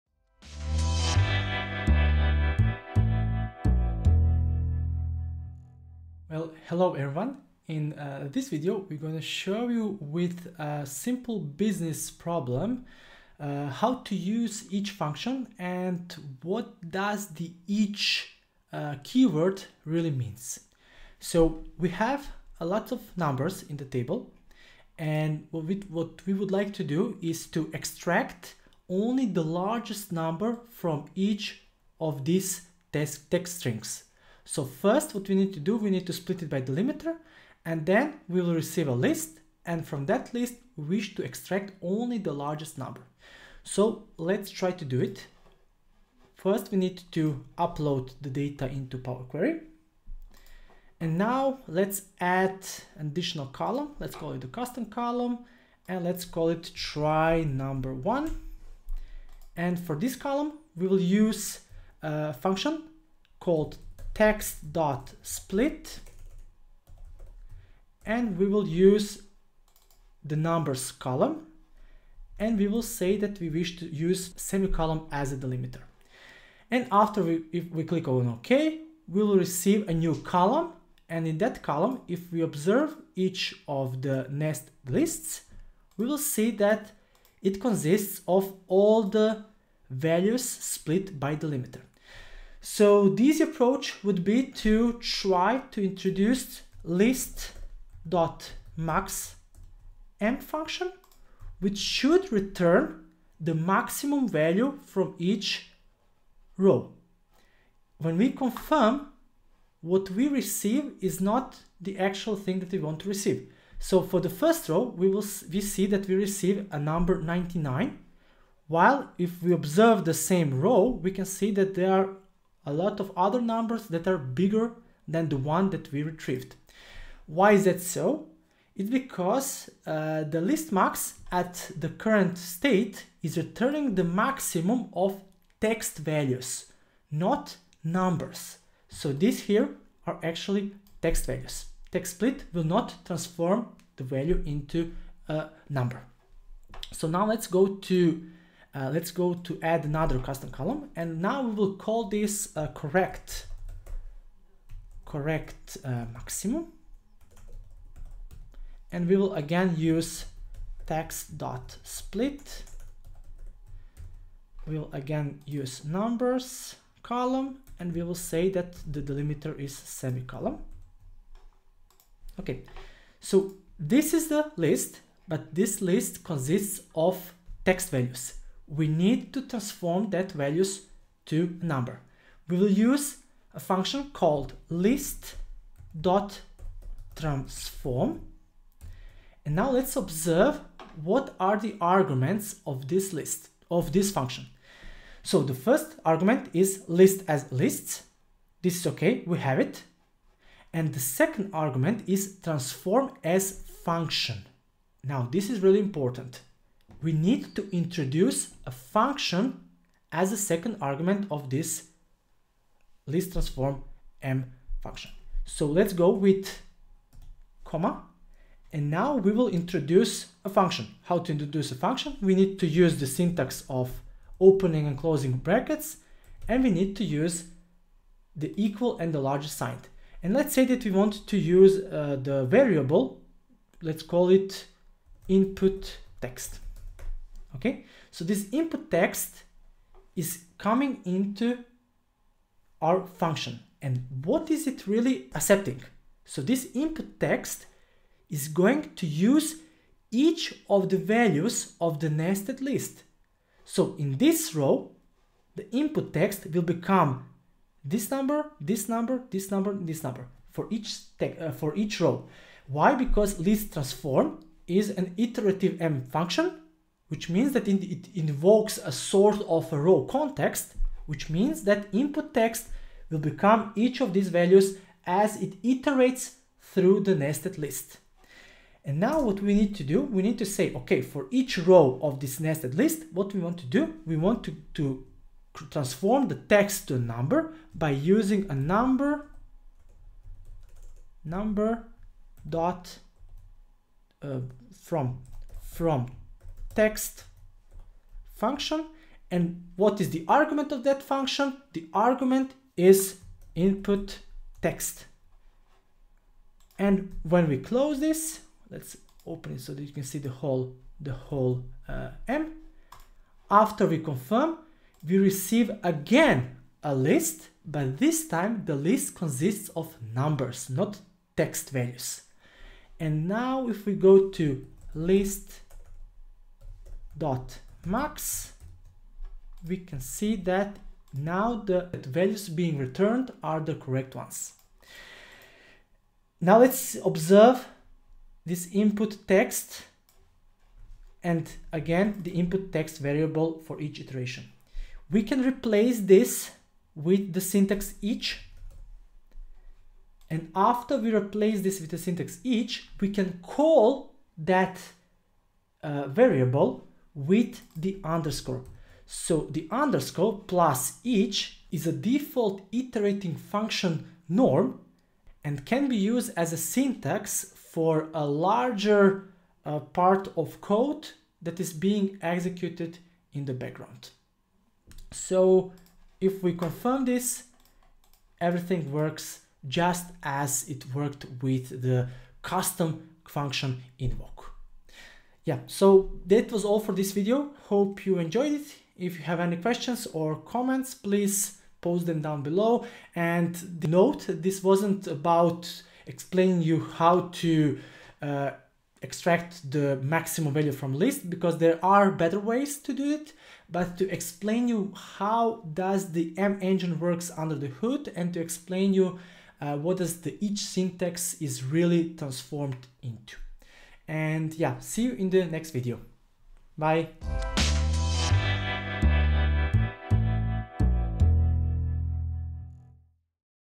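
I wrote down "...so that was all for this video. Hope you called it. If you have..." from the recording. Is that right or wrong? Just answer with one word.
wrong.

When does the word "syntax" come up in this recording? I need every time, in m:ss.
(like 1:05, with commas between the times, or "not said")
3:43, 5:47, 5:51, 6:06, 6:50.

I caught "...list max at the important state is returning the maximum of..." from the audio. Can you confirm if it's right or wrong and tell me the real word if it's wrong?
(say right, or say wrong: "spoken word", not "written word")
wrong: "current", not "important".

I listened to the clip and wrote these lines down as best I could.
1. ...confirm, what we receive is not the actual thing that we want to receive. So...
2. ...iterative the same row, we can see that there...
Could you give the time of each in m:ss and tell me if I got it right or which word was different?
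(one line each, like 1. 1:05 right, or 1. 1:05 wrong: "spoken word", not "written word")
1. 1:48 right
2. 1:59 wrong: "observe", not "iterative".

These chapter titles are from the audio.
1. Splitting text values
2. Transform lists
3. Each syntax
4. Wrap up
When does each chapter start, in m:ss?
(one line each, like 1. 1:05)
1. 0:45
2. 3:02
3. 5:36
4. 6:25.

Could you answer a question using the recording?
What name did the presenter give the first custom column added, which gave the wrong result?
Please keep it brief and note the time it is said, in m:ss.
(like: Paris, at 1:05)
try number one, at 0:56.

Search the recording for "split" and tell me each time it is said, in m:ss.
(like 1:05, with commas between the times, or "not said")
0:36, 1:05, 1:30, 2:22, 2:41.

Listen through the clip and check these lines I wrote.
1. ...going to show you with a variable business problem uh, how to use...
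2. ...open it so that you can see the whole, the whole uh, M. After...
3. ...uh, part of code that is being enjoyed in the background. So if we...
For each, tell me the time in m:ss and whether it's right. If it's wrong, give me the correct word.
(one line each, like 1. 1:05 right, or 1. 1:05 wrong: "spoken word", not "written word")
1. 0:08 wrong: "simple", not "variable"
2. 5:09 right
3. 6:09 wrong: "executed", not "enjoyed".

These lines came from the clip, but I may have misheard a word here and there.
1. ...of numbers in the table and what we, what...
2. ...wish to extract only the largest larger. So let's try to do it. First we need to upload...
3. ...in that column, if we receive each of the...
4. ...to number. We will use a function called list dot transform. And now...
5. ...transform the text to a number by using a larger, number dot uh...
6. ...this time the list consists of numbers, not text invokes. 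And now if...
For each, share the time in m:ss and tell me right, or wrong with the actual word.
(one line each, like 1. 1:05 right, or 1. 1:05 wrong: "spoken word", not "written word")
1. 0:22 right
2. 0:40 wrong: "number", not "larger"
3. 1:21 wrong: "observe", not "receive"
4. 3:01 right
5. 4:45 wrong: "number", not "larger"
6. 5:17 wrong: "values", not "invokes".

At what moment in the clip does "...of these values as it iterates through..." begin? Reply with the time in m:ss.
4:33.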